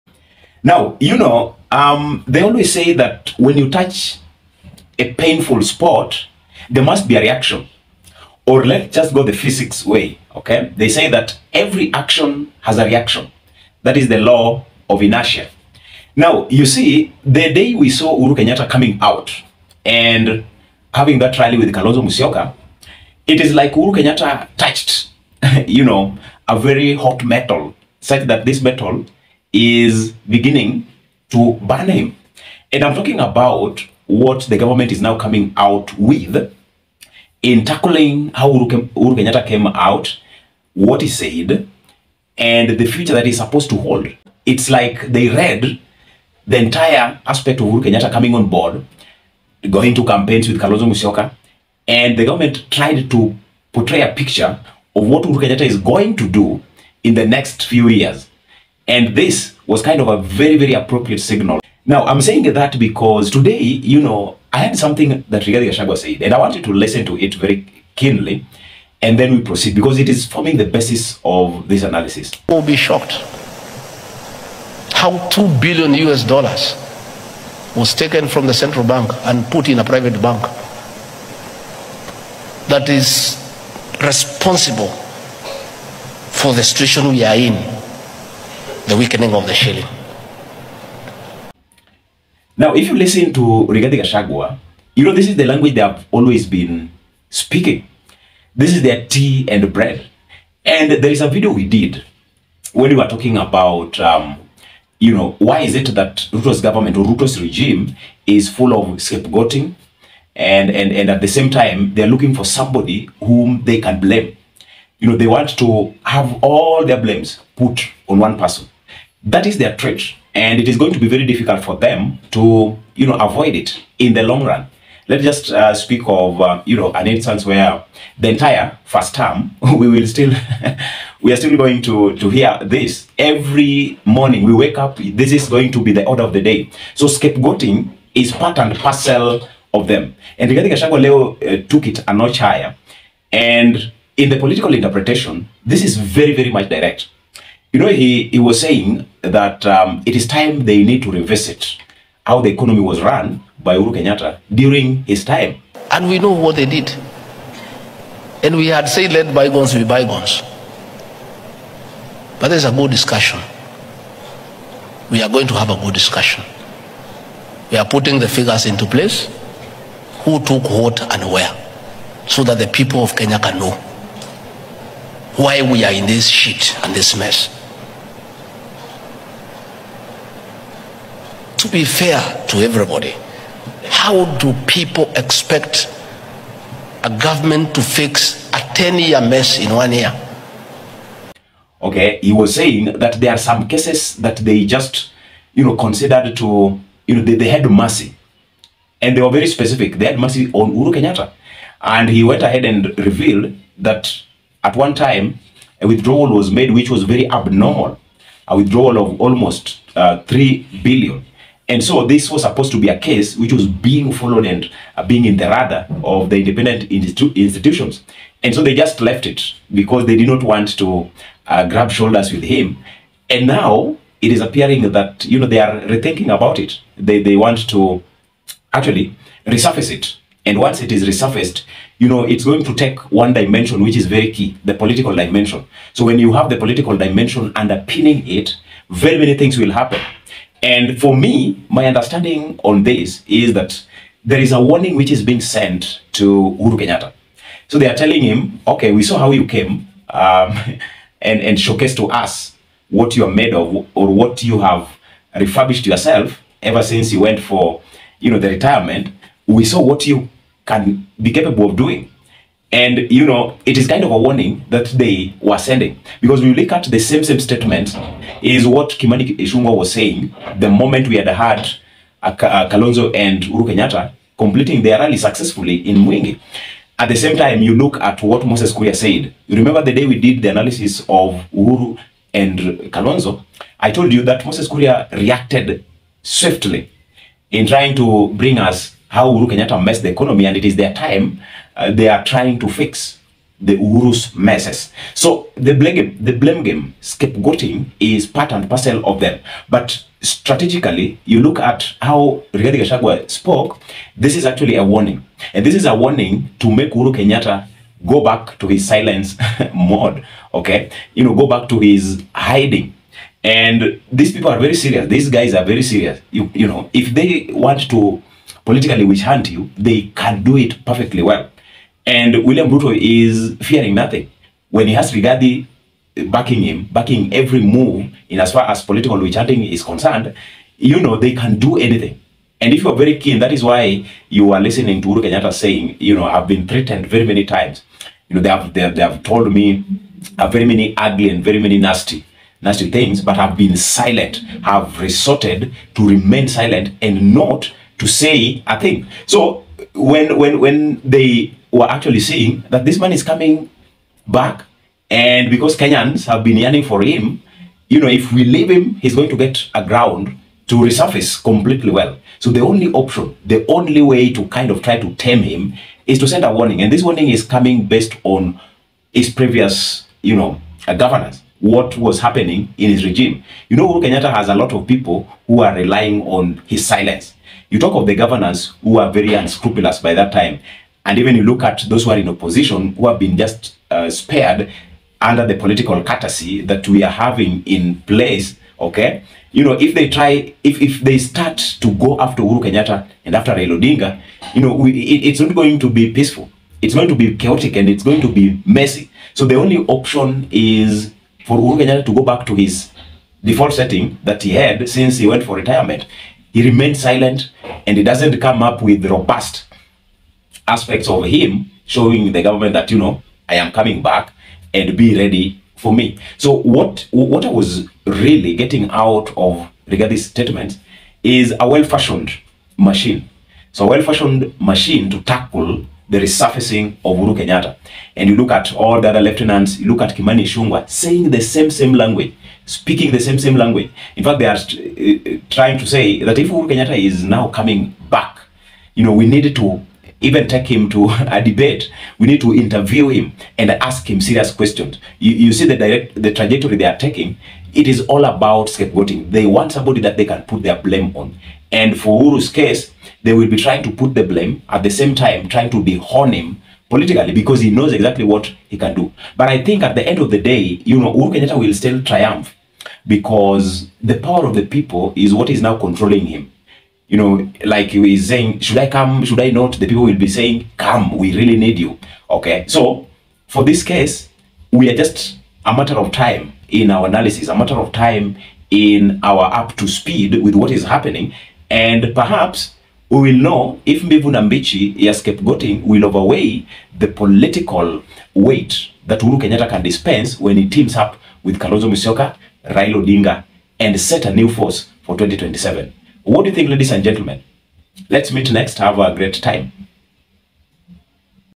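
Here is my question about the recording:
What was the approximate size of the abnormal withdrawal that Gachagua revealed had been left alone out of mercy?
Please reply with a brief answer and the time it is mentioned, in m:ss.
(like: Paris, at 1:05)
almost 3 billion, at 3:29.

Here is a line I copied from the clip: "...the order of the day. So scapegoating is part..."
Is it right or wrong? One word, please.
right.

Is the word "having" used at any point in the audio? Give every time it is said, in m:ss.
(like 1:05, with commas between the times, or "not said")
0:20, 6:27.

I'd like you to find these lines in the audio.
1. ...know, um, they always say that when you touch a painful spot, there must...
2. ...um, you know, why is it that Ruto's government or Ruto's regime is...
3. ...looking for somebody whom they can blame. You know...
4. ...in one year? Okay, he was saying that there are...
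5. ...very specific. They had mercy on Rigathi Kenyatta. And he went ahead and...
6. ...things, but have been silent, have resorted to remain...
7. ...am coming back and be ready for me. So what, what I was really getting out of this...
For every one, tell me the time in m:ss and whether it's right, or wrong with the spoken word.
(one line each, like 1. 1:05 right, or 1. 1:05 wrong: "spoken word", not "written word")
1. 0:01 right
2. 1:44 right
3. 1:52 right
4. 3:09 right
5. 3:19 wrong: "Uhuru", not "Rigathi"
6. 5:42 right
7. 6:53 right.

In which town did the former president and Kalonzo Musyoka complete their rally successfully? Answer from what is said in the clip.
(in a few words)
Mwingi.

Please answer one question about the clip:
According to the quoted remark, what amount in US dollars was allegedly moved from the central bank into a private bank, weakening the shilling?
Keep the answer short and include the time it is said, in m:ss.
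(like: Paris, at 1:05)
2 billion US dollars, at 1:15.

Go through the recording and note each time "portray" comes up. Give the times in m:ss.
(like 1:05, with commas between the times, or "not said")
0:53.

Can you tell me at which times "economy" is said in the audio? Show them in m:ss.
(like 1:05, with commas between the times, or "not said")
2:32, 4:50.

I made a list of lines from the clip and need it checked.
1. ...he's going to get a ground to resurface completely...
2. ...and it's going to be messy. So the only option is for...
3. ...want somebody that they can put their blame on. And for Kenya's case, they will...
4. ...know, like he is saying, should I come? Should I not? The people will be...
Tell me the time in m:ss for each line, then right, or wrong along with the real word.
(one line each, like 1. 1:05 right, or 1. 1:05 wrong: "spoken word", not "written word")
1. 5:58 right
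2. 6:37 right
3. 7:29 wrong: "Uhuru", not "Kenya"
4. 7:47 right.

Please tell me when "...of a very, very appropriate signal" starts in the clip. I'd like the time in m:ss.
1:00.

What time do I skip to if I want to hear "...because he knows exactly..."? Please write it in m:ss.
7:37.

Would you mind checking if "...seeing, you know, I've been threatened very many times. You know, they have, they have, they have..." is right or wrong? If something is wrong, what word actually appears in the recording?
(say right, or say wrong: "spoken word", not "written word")
wrong: "saying", not "seeing".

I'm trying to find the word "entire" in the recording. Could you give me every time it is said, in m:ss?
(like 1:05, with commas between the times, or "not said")
0:46, 2:08.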